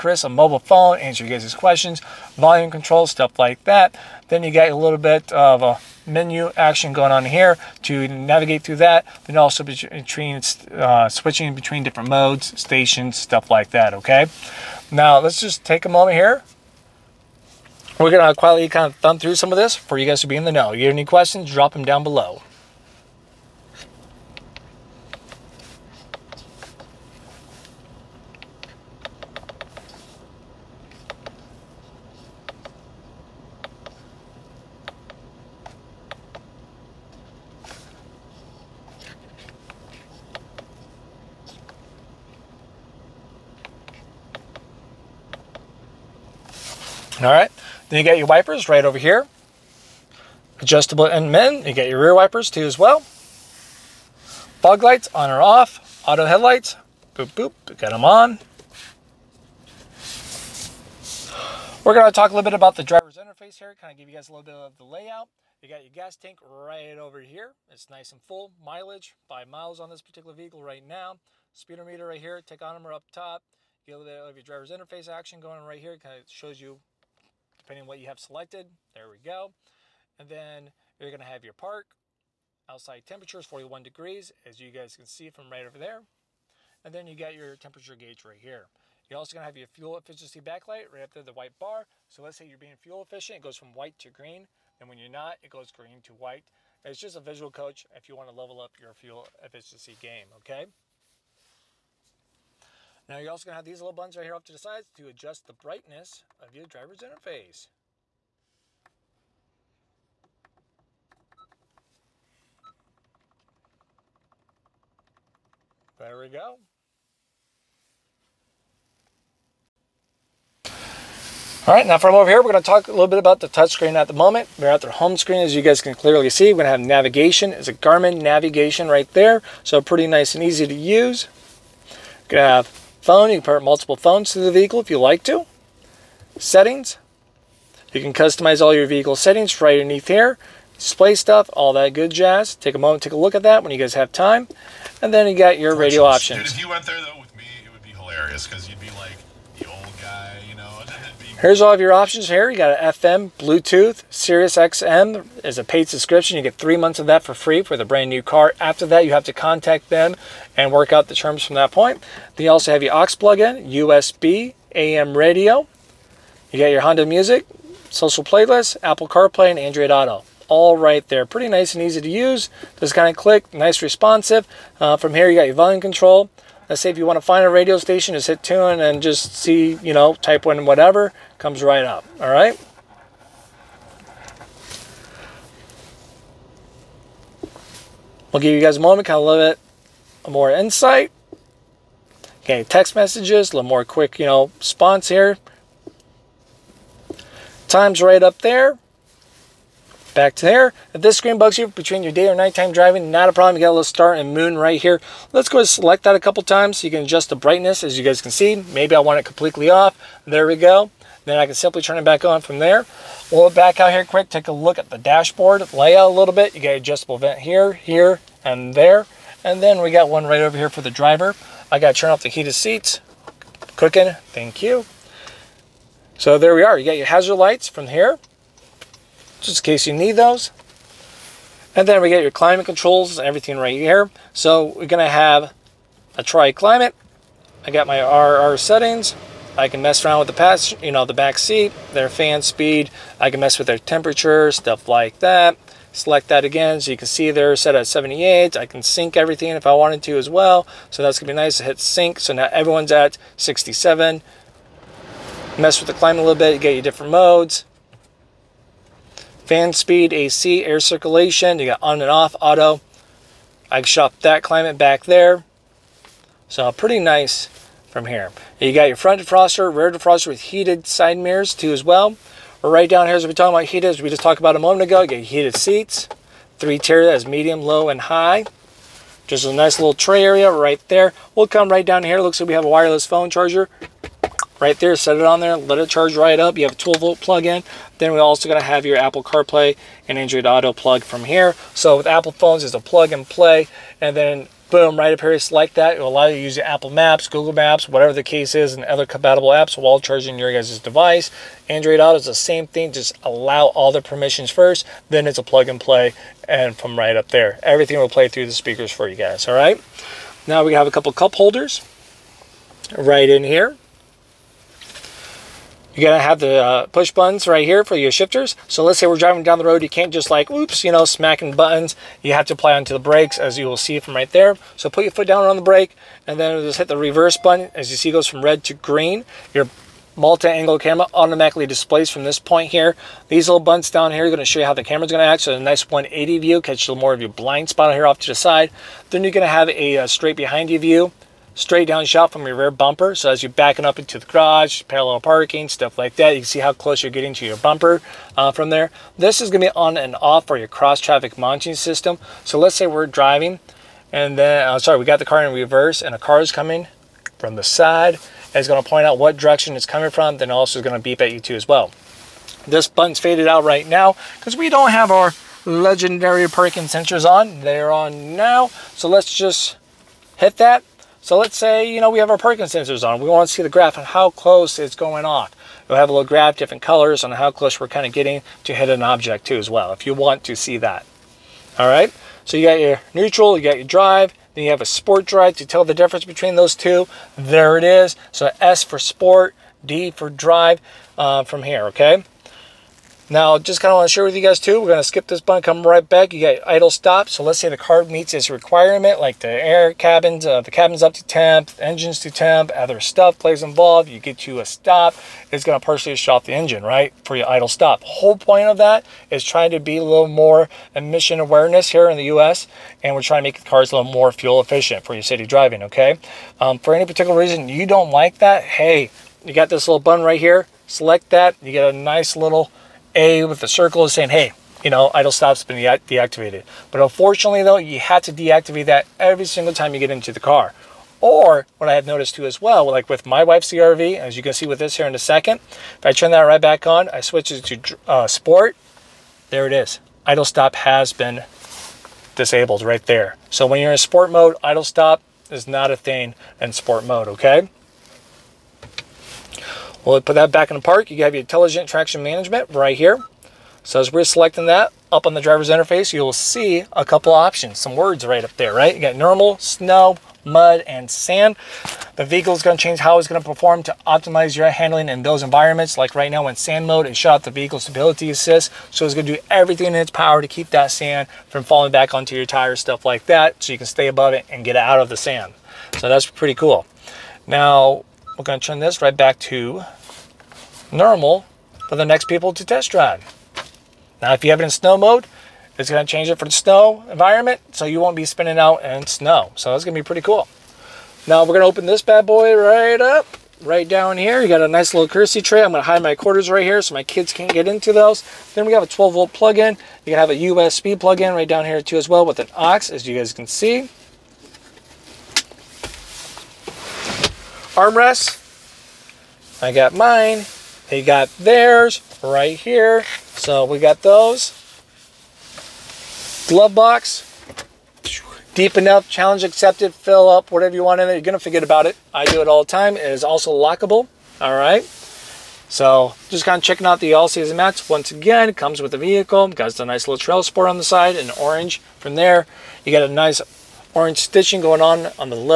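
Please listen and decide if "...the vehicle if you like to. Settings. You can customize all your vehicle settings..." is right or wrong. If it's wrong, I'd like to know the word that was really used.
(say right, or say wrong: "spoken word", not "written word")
right.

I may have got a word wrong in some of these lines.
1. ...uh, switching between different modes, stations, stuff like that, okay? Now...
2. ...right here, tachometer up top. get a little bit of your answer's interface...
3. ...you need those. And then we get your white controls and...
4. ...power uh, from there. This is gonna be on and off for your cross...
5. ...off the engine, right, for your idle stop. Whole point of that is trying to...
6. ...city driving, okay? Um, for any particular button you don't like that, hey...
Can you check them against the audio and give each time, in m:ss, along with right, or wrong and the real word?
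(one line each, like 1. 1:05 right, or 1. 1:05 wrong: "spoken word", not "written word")
1. 0:10 right
2. 1:12 wrong: "driver", not "answer"
3. 3:49 wrong: "climate", not "white"
4. 5:47 wrong: "bumper", not "power"
5. 6:46 right
6. 6:55 wrong: "reason", not "button".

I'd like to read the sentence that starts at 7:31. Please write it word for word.
You have your intelligent traction management right here.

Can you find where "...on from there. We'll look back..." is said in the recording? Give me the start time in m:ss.
3:32.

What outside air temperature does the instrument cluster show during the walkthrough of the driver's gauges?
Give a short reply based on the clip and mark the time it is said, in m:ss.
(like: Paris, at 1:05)
41, at 1:23.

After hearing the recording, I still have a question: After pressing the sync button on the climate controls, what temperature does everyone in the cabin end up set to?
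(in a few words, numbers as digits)
67.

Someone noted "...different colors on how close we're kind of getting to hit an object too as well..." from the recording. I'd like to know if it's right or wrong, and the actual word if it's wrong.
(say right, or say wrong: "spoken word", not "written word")
right.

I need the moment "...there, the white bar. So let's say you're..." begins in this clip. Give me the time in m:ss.
1:31.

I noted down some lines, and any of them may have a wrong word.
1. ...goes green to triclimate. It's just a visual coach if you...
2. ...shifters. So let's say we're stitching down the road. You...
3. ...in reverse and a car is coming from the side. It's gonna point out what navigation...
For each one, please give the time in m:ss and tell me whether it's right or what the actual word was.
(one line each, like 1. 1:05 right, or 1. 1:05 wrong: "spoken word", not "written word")
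1. 1:35 wrong: "white", not "triclimate"
2. 5:18 wrong: "driving", not "stitching"
3. 5:55 wrong: "direction", not "navigation".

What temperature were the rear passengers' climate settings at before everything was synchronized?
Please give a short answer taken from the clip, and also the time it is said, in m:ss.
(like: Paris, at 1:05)
78, at 4:07.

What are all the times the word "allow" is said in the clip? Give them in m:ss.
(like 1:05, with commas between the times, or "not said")
4:56, 5:03.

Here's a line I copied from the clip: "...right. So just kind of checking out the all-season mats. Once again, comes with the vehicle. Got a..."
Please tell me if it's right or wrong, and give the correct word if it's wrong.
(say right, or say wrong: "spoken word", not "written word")
right.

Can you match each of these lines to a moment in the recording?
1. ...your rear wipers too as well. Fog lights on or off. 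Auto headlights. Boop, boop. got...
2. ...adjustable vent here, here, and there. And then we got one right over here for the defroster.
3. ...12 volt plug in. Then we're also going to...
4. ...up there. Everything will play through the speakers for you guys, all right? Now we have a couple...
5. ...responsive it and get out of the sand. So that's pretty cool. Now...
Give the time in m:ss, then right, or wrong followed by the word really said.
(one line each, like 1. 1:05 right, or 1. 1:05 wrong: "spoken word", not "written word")
1. 0:51 right
2. 3:36 wrong: "driver", not "defroster"
3. 4:46 right
4. 5:07 right
5. 7:54 wrong: "above", not "responsive".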